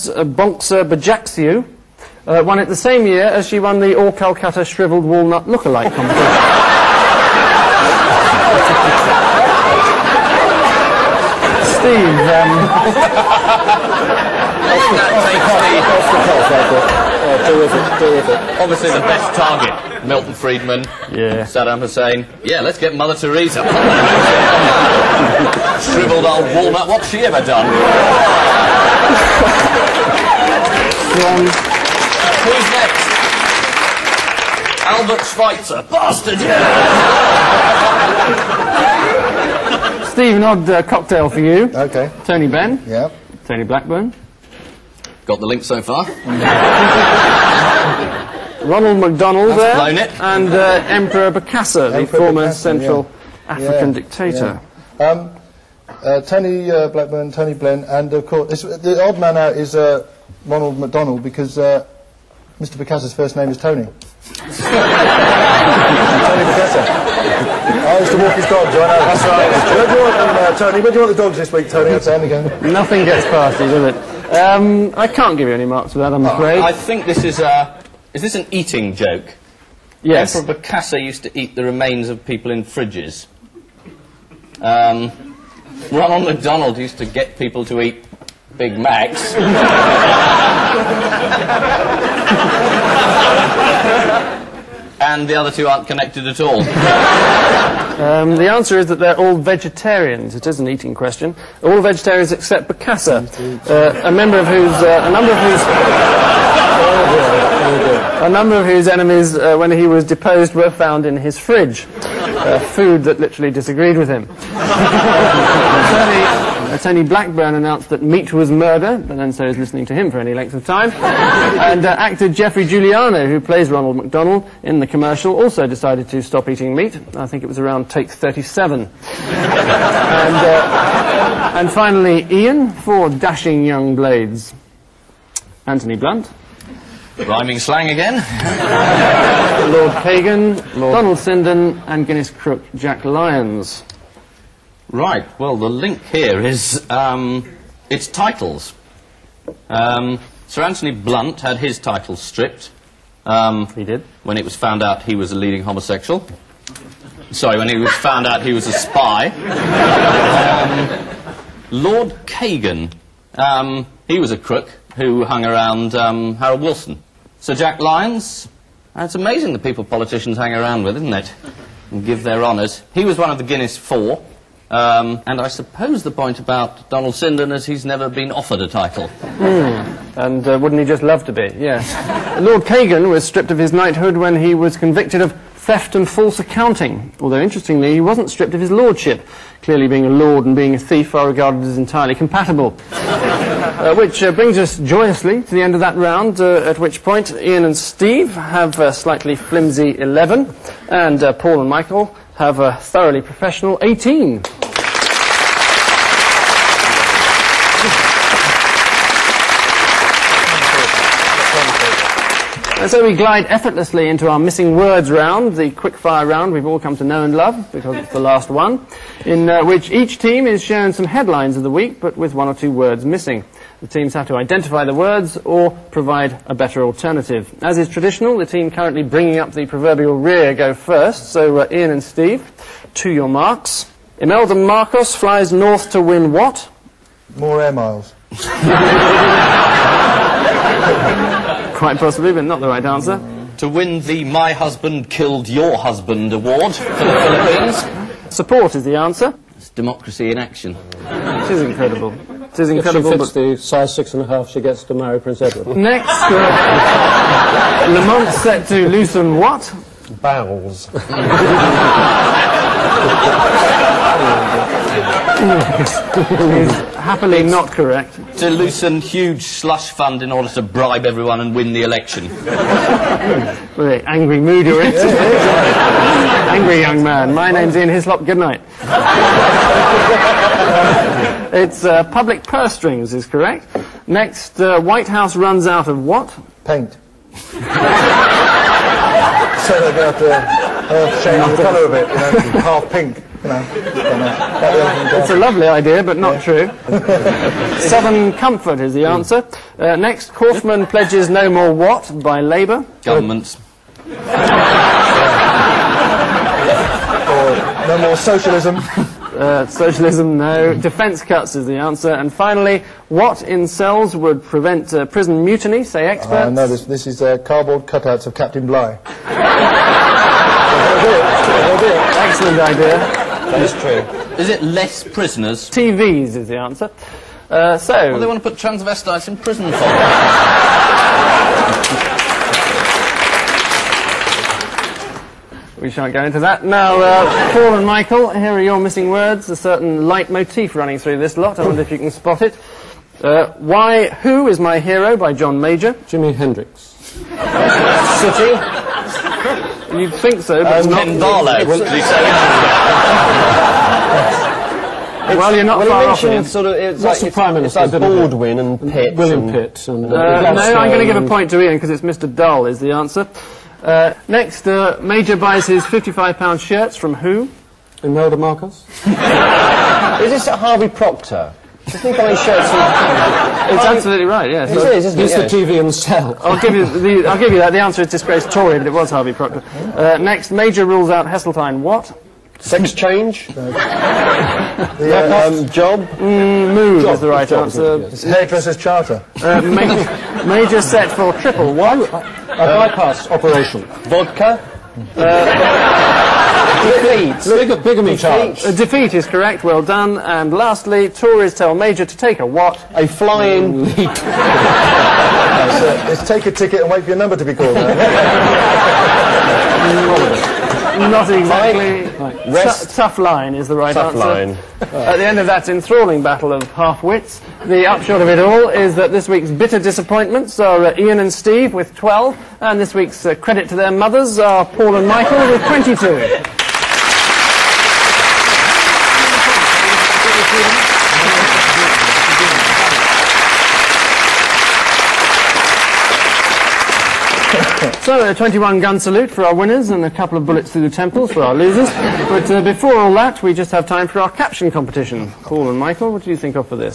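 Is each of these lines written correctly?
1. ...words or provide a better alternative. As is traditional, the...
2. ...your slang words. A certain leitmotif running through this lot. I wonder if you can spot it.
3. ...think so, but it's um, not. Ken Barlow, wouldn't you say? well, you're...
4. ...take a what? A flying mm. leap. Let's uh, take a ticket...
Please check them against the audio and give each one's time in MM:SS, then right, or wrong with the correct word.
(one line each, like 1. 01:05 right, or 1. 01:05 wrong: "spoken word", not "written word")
1. 03:44 right
2. 05:38 wrong: "missing", not "slang"
3. 05:50 right
4. 06:42 right.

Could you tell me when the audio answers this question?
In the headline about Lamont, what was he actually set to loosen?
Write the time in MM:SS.
04:42.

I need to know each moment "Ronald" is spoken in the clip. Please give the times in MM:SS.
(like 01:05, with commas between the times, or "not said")
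00:48, 01:00, 01:25, 02:03.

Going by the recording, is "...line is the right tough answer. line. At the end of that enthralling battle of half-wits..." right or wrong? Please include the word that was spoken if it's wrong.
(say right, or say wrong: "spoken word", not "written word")
right.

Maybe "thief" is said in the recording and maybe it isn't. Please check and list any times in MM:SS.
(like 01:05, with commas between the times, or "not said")
03:10.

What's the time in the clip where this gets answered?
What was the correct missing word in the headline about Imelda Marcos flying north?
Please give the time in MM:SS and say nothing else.
04:08.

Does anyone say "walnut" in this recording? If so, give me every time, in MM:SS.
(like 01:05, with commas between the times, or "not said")
00:05, 00:26.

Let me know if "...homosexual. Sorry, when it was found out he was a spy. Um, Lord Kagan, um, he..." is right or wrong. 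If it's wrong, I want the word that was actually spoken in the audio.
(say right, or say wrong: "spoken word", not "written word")
right.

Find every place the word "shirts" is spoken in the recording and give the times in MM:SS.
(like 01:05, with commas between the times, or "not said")
06:06, 06:12.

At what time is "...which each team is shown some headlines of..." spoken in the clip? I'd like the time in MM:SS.
03:39.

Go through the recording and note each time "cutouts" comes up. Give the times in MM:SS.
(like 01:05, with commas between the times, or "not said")
05:17.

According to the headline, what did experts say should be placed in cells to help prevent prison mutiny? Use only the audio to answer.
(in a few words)
TVs.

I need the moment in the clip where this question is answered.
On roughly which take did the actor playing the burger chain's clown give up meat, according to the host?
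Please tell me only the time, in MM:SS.
02:07.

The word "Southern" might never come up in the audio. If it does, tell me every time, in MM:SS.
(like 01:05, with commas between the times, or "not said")
04:57.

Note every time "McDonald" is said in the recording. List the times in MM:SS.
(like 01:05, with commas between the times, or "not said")
00:48, 01:00, 01:26, 02:03.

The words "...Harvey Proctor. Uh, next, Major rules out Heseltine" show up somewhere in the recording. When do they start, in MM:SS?
06:19.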